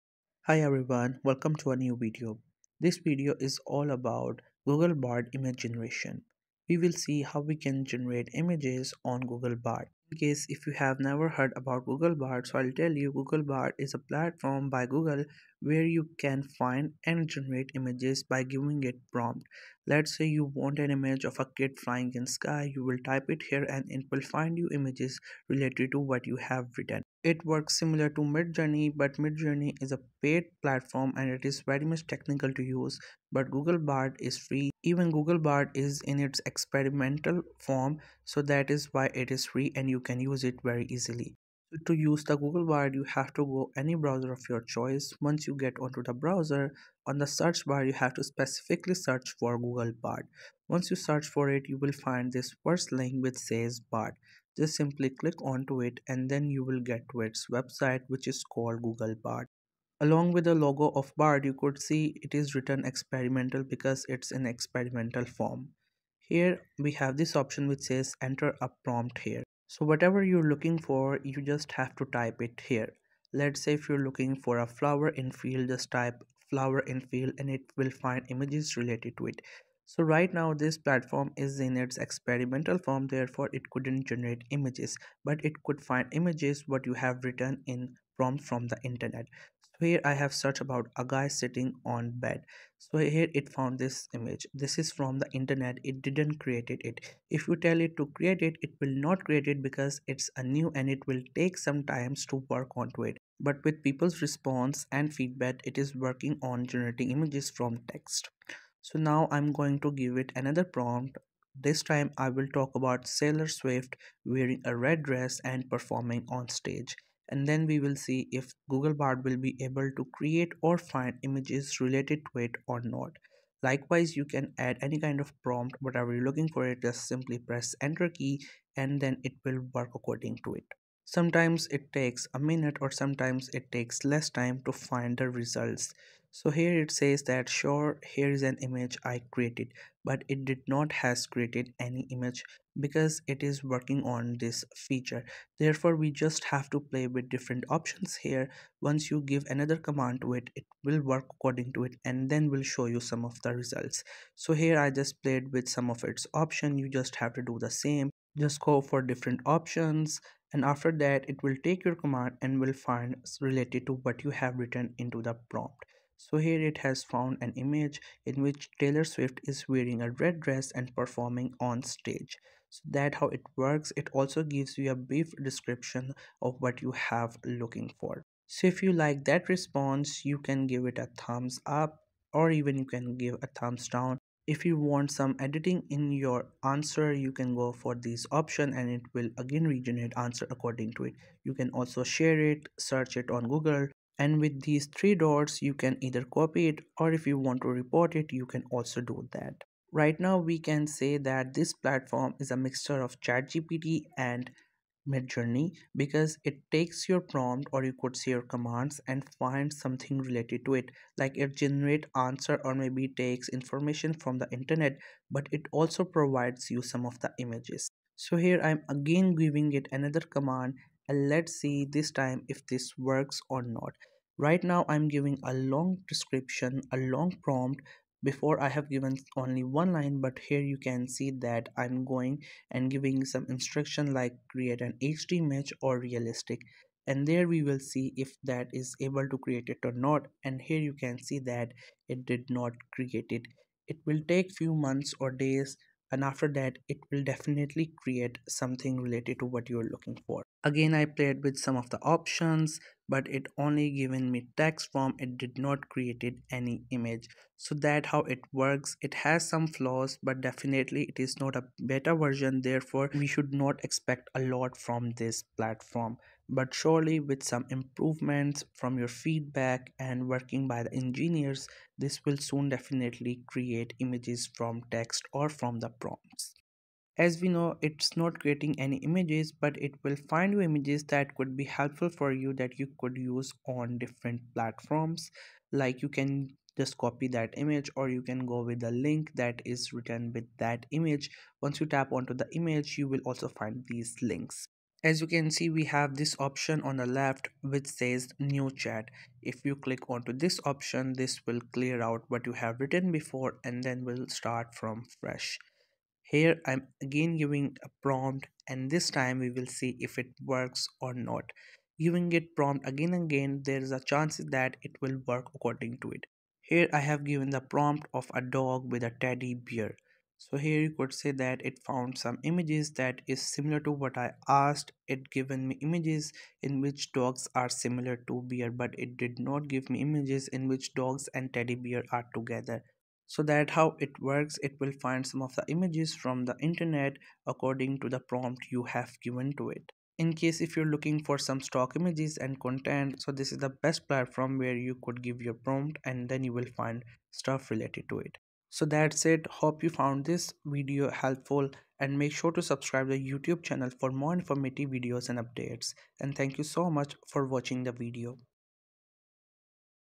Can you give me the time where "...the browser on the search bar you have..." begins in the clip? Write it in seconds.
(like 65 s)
46 s.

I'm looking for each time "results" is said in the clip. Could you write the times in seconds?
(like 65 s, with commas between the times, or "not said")
135 s, 153 s.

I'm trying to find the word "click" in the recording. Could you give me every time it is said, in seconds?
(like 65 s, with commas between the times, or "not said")
55 s, 299 s.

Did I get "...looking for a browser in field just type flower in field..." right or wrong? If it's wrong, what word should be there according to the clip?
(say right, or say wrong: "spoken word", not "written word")
wrong: "flower", not "browser".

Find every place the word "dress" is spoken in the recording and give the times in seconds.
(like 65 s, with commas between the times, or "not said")
115 s, 170 s.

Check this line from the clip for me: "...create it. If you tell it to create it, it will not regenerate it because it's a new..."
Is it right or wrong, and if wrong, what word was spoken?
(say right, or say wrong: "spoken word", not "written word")
wrong: "create", not "regenerate".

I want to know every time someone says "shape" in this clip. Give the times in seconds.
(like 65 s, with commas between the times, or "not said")
not said.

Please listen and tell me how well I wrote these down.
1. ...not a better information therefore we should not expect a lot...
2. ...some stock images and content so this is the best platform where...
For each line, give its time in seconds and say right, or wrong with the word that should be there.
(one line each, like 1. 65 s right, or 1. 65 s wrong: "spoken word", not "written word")
1. 261 s wrong: "version", not "information"
2. 341 s right.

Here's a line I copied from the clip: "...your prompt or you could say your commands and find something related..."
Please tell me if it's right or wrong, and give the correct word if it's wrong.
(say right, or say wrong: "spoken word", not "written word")
right.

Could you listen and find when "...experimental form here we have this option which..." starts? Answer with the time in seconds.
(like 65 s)
64 s.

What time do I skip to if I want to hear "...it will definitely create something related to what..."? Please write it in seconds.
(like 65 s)
246 s.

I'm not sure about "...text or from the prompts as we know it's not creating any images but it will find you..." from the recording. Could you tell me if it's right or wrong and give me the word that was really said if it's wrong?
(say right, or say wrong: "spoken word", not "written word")
right.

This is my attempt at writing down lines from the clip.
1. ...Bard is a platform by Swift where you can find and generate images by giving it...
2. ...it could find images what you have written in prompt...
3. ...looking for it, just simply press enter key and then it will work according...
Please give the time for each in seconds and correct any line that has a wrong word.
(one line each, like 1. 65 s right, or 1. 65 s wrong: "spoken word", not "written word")
1. 13 s wrong: "Google", not "Swift"
2. 85 s right
3. 126 s right.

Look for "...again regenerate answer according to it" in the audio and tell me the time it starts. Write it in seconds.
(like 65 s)
189 s.